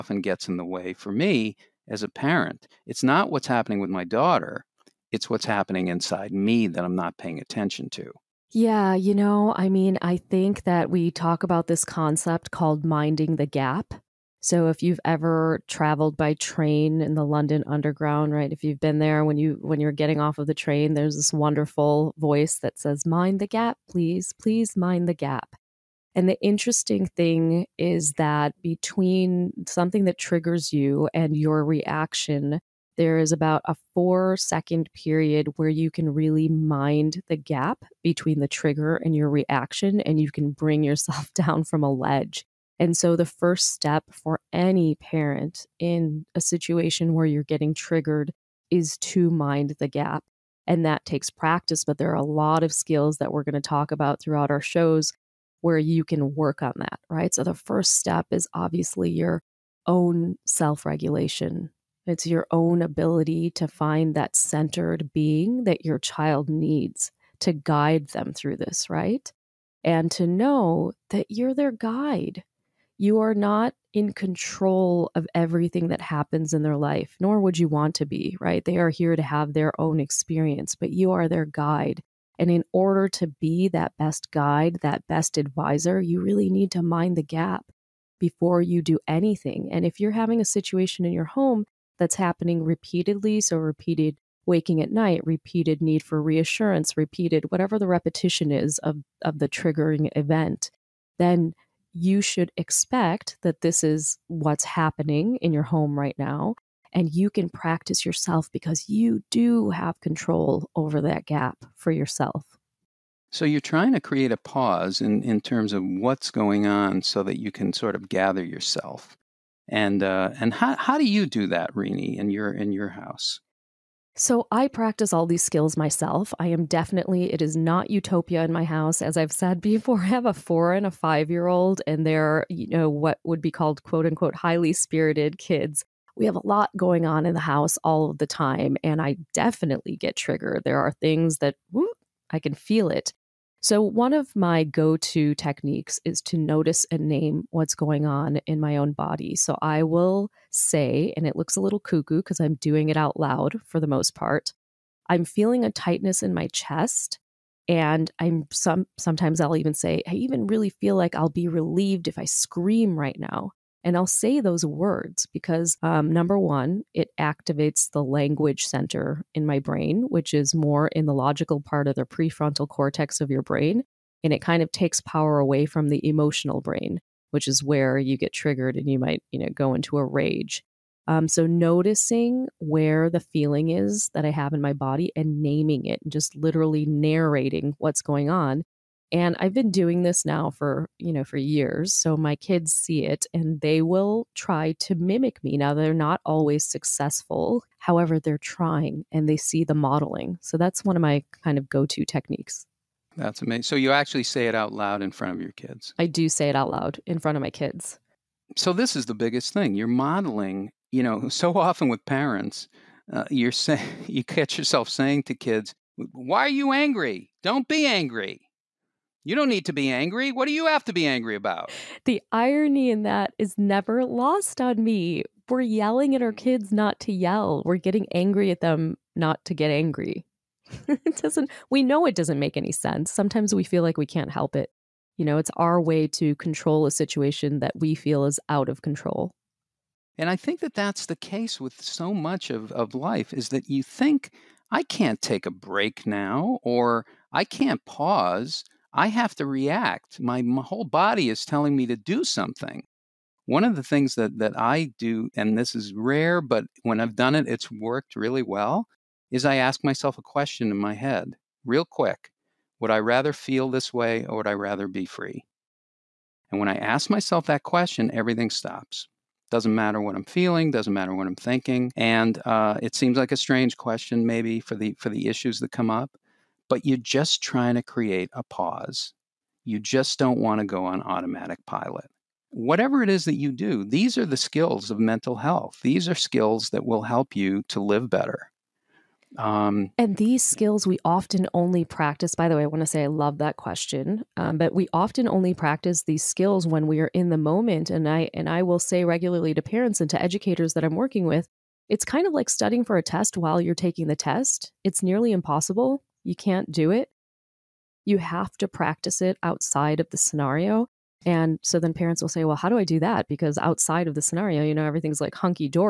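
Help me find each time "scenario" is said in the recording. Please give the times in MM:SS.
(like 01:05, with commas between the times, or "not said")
05:10, 05:14.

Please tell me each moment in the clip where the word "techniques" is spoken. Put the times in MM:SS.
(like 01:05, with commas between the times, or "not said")
02:25, 03:22.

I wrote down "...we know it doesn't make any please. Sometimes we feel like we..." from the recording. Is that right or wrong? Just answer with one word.
wrong.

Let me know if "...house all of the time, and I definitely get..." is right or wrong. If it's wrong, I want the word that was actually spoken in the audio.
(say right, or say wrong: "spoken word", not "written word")
right.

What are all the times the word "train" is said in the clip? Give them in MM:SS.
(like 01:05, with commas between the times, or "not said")
00:16, 00:20.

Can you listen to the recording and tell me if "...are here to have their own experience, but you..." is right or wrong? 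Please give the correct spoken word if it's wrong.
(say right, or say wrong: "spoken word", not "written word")
right.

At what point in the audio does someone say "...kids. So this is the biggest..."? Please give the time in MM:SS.
03:27.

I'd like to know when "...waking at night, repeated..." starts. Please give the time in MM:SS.
01:34.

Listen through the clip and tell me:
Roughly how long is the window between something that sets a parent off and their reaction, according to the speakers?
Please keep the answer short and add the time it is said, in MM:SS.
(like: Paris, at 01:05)
4 seconds, at 00:33.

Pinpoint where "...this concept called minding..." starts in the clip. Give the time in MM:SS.
00:11.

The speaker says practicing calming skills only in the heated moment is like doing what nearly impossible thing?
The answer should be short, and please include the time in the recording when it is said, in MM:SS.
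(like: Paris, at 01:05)
Studying for a test, at 05:02.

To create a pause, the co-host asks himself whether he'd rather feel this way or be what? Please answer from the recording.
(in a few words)
Free.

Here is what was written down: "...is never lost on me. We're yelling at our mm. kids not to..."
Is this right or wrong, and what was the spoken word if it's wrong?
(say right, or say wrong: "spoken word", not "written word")
right.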